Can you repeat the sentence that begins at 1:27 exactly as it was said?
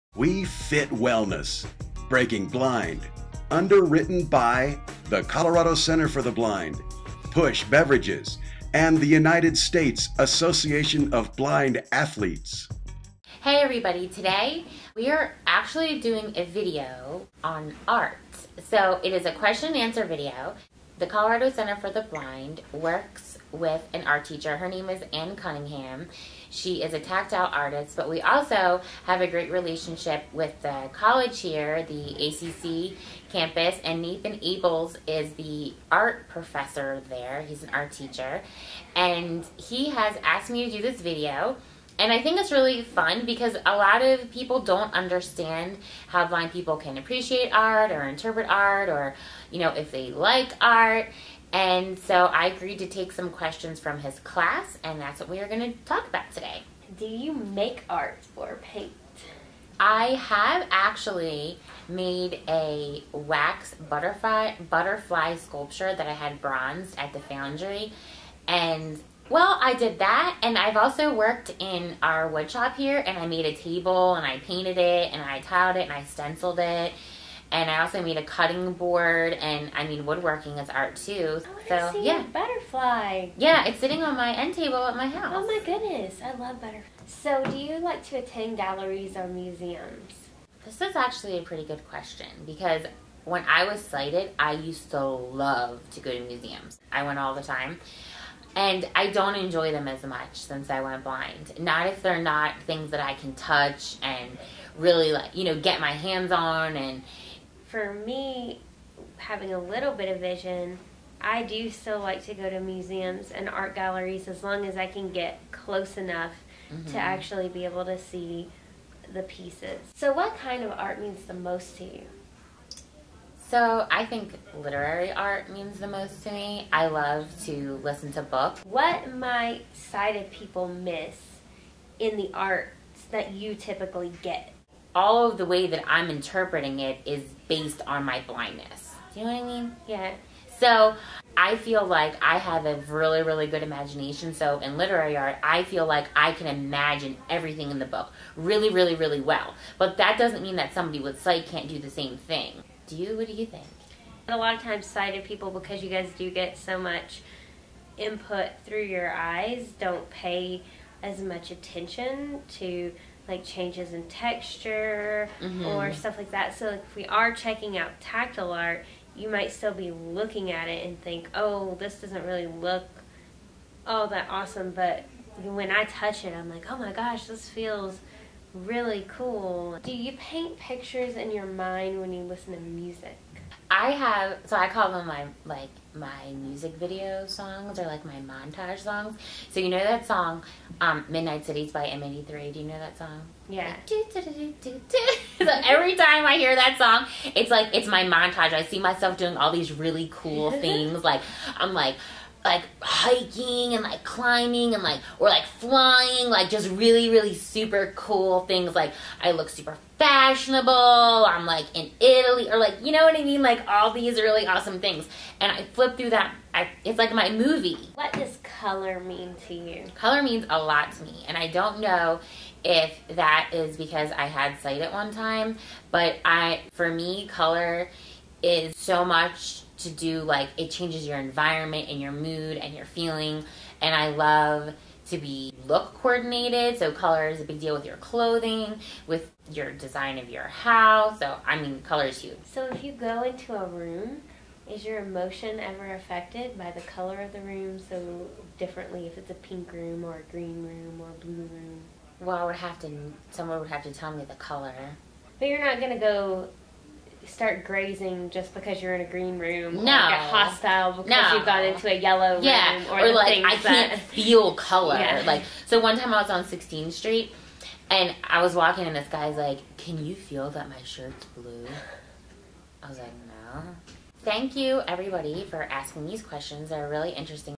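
So, do you like to attend galleries or museums?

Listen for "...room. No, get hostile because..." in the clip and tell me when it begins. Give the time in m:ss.
4:19.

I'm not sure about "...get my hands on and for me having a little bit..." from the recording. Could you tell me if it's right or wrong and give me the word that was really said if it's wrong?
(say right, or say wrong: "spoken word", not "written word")
right.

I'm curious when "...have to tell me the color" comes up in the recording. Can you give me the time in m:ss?
4:13.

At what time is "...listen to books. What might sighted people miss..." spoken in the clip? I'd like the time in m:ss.
2:07.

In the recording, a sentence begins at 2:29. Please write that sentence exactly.
But that doesn't mean that somebody with sight can't do the same thing.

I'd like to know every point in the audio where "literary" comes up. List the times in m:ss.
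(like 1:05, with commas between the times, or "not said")
2:04, 2:24.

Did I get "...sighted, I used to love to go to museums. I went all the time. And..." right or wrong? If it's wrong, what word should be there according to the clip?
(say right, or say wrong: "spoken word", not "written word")
right.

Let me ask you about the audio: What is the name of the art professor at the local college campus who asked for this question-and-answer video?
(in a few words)
Nathan Abels.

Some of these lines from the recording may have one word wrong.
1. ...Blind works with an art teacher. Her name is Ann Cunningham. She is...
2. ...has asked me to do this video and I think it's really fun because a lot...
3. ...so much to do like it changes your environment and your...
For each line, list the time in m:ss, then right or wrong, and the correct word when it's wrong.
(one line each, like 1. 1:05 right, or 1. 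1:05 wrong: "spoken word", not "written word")
1. 0:22 right
2. 0:39 right
3. 3:48 right.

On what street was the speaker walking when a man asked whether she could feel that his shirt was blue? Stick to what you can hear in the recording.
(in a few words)
16th Street.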